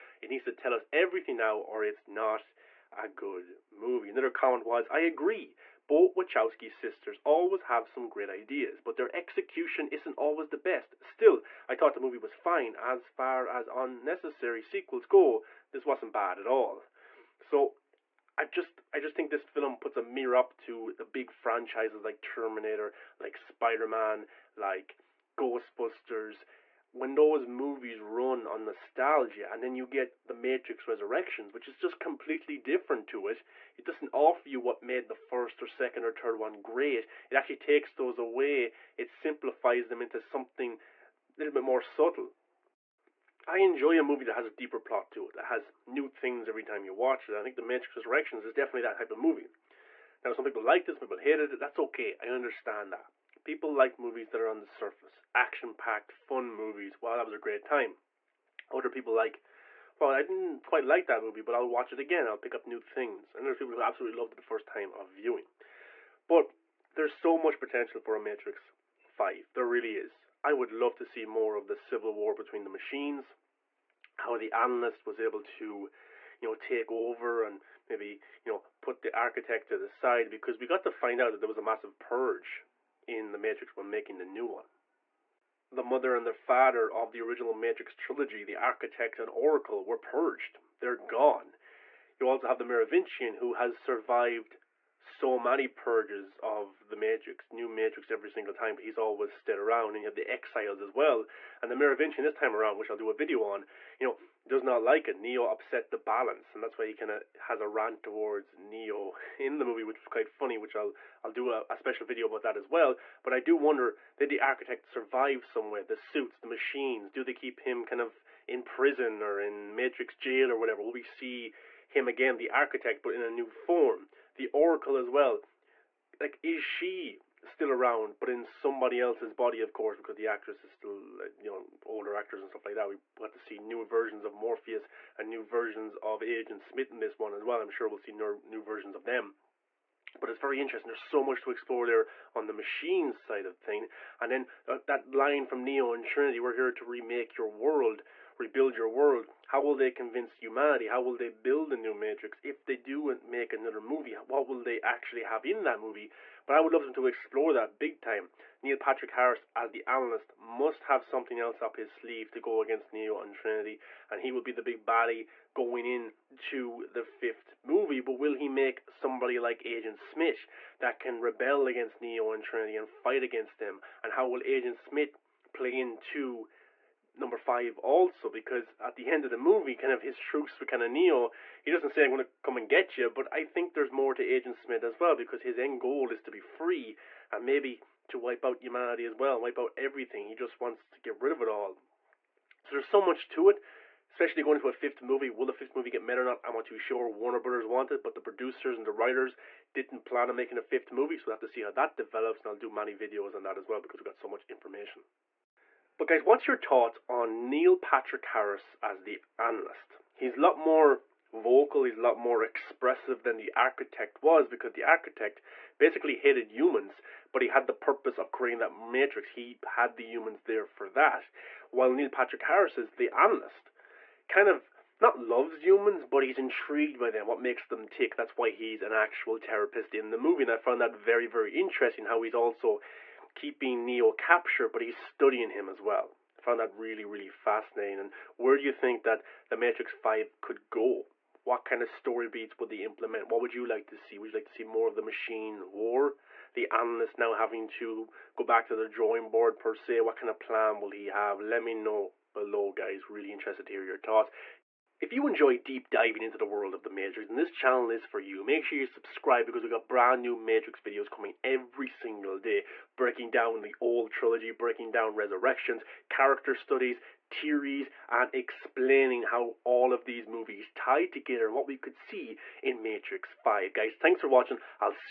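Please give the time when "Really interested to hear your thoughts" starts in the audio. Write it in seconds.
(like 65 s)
253 s.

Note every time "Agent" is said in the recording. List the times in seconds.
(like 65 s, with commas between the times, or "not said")
136 s, 169 s, 174 s, 184 s.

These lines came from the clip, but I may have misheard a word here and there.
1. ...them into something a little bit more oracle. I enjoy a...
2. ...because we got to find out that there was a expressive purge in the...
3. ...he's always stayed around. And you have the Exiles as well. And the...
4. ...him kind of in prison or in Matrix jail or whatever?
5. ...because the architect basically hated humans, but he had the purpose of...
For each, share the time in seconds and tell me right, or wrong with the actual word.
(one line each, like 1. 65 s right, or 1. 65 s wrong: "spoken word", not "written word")
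1. 39 s wrong: "subtle", not "oracle"
2. 80 s wrong: "massive", not "expressive"
3. 98 s right
4. 117 s right
5. 214 s right.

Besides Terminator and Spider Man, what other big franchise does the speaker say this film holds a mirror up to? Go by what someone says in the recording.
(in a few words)
Ghostbusters.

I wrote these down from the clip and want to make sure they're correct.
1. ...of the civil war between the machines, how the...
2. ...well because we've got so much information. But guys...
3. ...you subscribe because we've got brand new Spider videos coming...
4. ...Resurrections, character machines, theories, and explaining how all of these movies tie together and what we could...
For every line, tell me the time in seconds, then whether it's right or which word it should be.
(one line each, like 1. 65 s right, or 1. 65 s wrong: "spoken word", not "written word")
1. 71 s right
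2. 203 s right
3. 258 s wrong: "Matrix", not "Spider"
4. 265 s wrong: "studies", not "machines".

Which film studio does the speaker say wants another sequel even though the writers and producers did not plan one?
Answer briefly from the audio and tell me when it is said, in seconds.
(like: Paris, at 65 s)
Warner Brothers, at 197 s.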